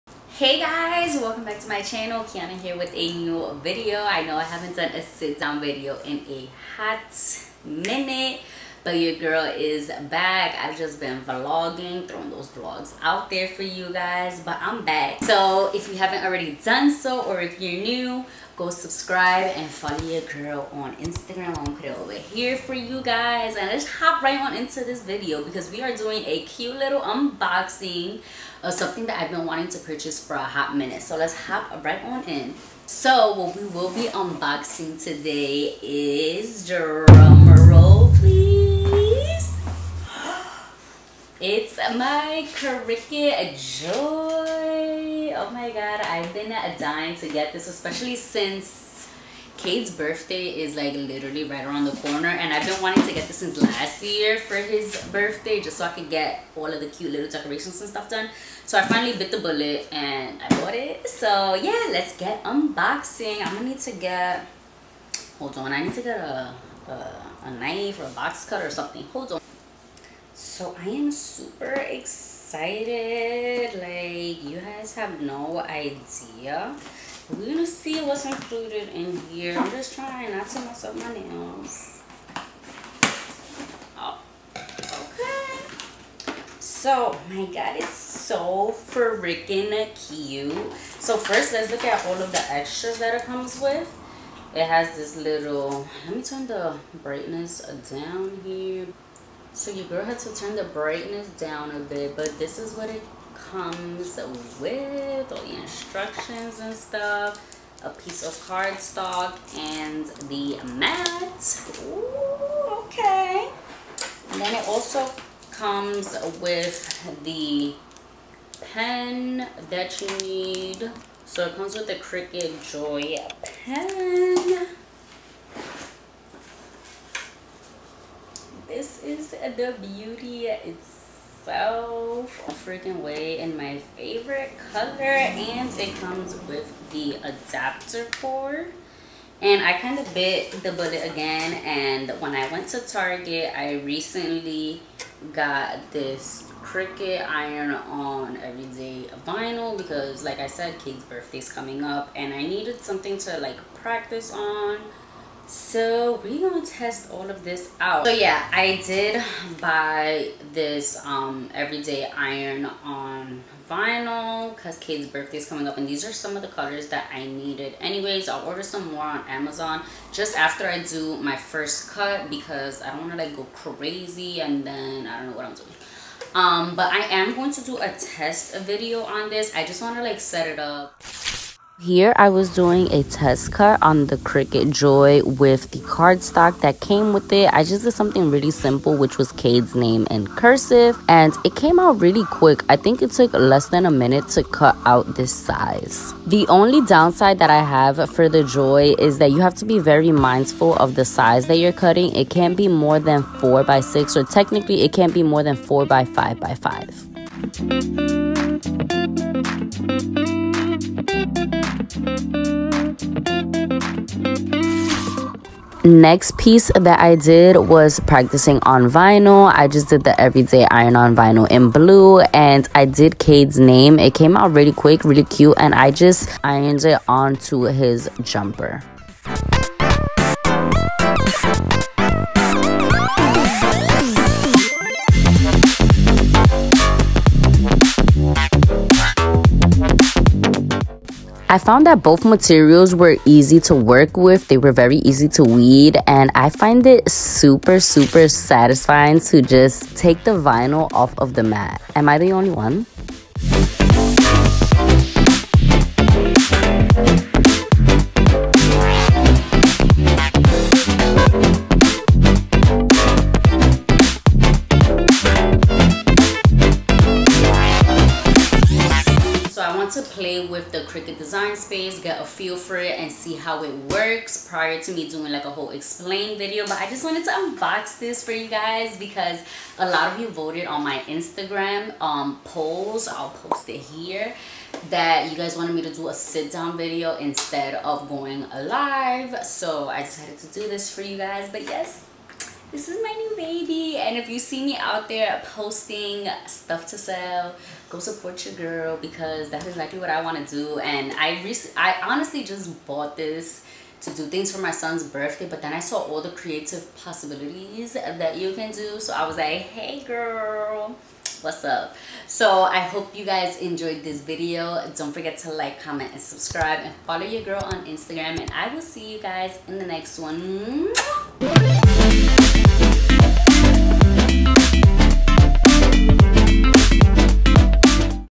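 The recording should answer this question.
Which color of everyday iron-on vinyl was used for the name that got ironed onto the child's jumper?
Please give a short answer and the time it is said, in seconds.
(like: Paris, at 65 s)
blue, at 221 s.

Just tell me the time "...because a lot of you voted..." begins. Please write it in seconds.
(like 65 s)
278 s.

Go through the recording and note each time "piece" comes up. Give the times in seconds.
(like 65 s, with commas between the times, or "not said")
107 s, 216 s.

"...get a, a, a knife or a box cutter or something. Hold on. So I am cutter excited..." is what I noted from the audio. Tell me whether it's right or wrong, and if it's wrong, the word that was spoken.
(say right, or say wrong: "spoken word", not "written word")
wrong: "super", not "cutter".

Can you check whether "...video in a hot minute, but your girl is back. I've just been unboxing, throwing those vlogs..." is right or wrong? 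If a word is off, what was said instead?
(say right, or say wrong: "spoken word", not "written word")
wrong: "vlogging", not "unboxing".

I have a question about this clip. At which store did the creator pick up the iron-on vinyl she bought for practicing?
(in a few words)
Target.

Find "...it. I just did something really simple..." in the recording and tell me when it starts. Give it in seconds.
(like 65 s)
187 s.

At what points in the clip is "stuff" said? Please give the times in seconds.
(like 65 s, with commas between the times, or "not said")
57 s, 106 s, 296 s.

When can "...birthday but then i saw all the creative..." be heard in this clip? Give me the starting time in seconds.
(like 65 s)
305 s.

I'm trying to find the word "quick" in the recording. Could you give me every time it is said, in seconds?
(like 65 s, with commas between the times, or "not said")
192 s, 224 s.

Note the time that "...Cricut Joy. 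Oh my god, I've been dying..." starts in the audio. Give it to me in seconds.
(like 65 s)
42 s.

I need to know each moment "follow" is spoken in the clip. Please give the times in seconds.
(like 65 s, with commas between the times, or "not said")
19 s, 317 s.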